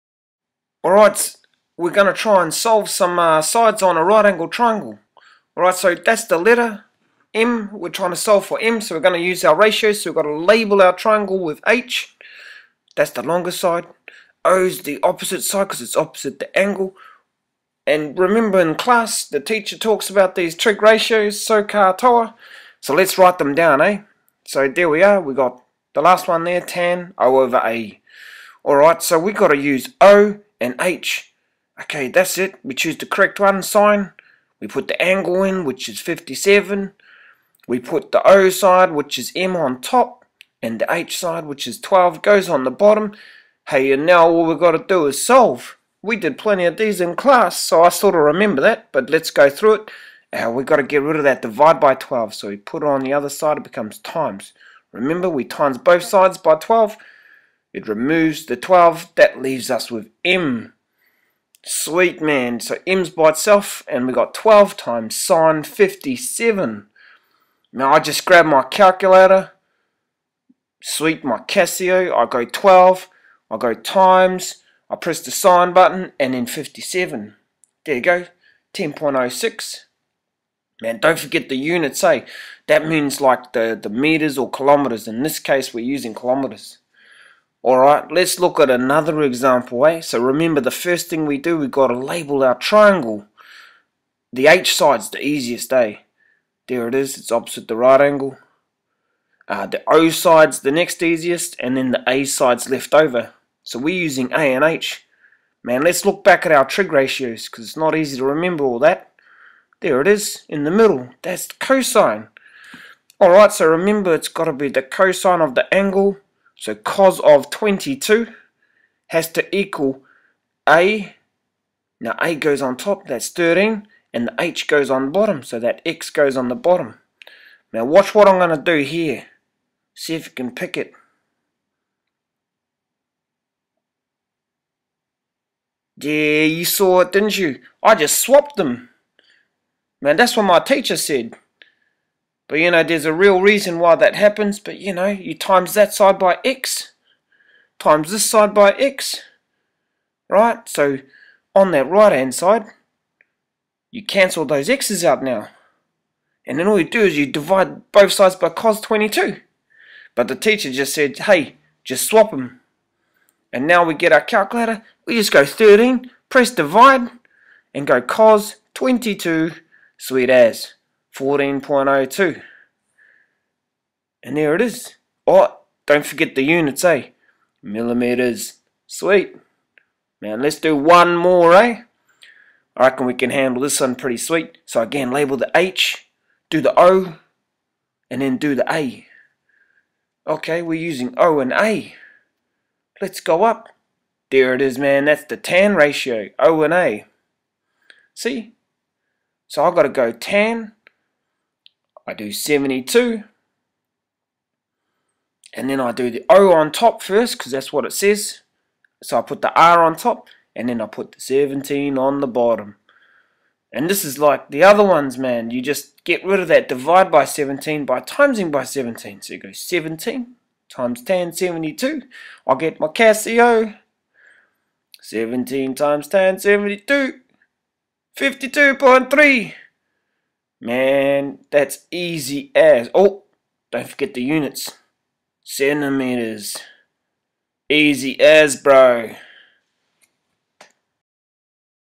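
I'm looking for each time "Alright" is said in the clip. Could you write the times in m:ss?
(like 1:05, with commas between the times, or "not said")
0:00, 0:05, 0:28, 1:27, 1:53.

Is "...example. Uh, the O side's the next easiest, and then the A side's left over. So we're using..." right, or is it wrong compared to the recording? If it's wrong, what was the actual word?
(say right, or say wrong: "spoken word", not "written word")
wrong: "angle", not "example".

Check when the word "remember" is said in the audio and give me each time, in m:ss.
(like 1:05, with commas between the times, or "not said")
0:18, 0:48, 0:54, 1:30, 1:48, 1:53.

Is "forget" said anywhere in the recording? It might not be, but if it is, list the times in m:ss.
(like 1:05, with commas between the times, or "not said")
1:21, 2:56, 3:53.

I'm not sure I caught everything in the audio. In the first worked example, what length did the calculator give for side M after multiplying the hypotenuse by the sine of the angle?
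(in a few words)
10.06.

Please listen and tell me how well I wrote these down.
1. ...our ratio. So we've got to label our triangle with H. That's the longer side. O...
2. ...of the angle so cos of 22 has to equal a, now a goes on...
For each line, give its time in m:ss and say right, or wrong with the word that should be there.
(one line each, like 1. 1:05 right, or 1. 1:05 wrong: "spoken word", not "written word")
1. 0:09 right
2. 1:55 right.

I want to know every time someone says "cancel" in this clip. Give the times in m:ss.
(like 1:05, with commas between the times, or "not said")
2:34.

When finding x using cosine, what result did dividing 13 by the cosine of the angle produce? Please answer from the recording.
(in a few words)
14.02.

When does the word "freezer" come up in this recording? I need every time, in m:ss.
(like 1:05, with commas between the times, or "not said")
not said.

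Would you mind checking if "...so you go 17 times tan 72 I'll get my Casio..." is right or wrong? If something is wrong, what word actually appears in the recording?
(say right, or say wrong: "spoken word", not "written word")
right.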